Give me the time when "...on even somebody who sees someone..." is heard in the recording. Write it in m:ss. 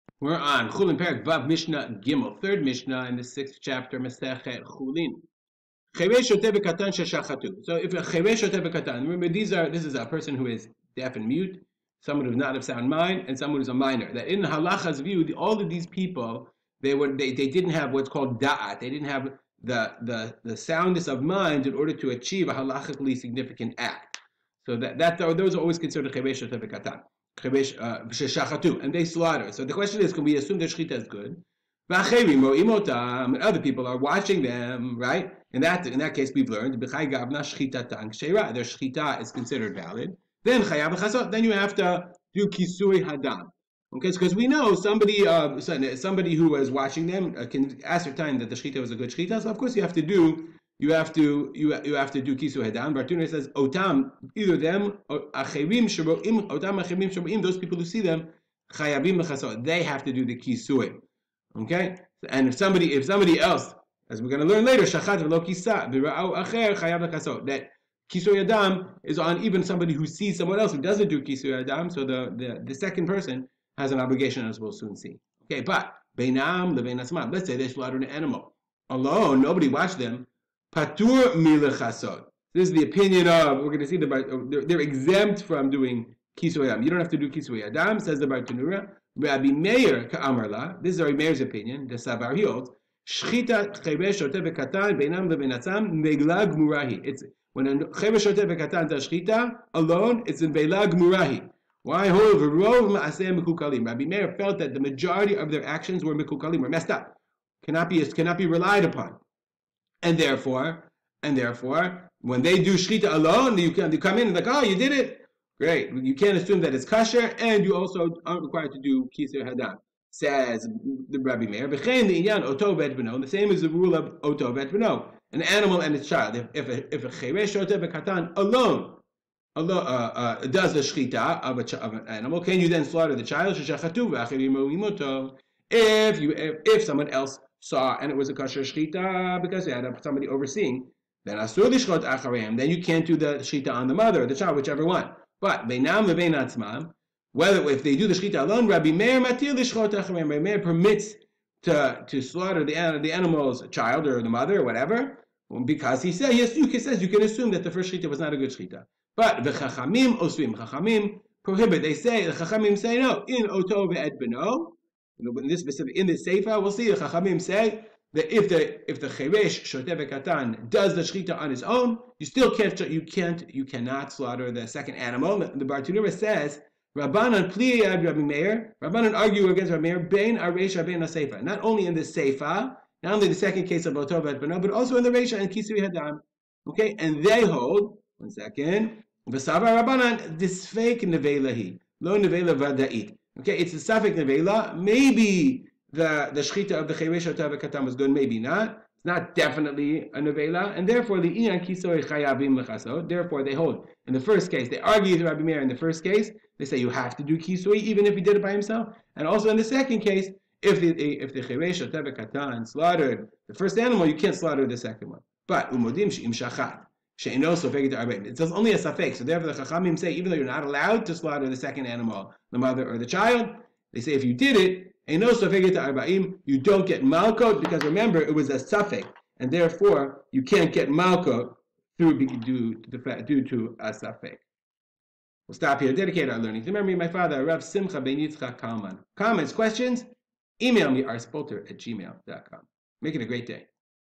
1:09.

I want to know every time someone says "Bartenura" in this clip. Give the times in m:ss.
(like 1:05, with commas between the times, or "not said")
0:52, 1:28, 2:55.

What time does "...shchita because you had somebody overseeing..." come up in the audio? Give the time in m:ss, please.
2:18.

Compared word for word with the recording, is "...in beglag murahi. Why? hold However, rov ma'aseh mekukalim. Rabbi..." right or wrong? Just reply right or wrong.
right.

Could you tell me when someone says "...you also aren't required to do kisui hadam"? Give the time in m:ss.
1:57.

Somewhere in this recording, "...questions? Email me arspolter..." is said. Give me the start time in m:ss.
3:59.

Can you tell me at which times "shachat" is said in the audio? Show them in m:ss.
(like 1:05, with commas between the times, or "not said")
1:04, 3:36.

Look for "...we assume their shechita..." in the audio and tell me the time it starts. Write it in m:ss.
0:30.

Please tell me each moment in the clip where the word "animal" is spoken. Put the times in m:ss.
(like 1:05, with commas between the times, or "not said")
1:18, 2:05, 2:12, 2:33, 2:54, 3:33, 3:41.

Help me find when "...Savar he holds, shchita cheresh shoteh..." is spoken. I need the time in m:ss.
1:31.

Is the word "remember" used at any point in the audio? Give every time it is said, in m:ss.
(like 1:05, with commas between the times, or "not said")
0:08, 3:47.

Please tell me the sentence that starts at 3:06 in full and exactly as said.
Okay, and they hold one second.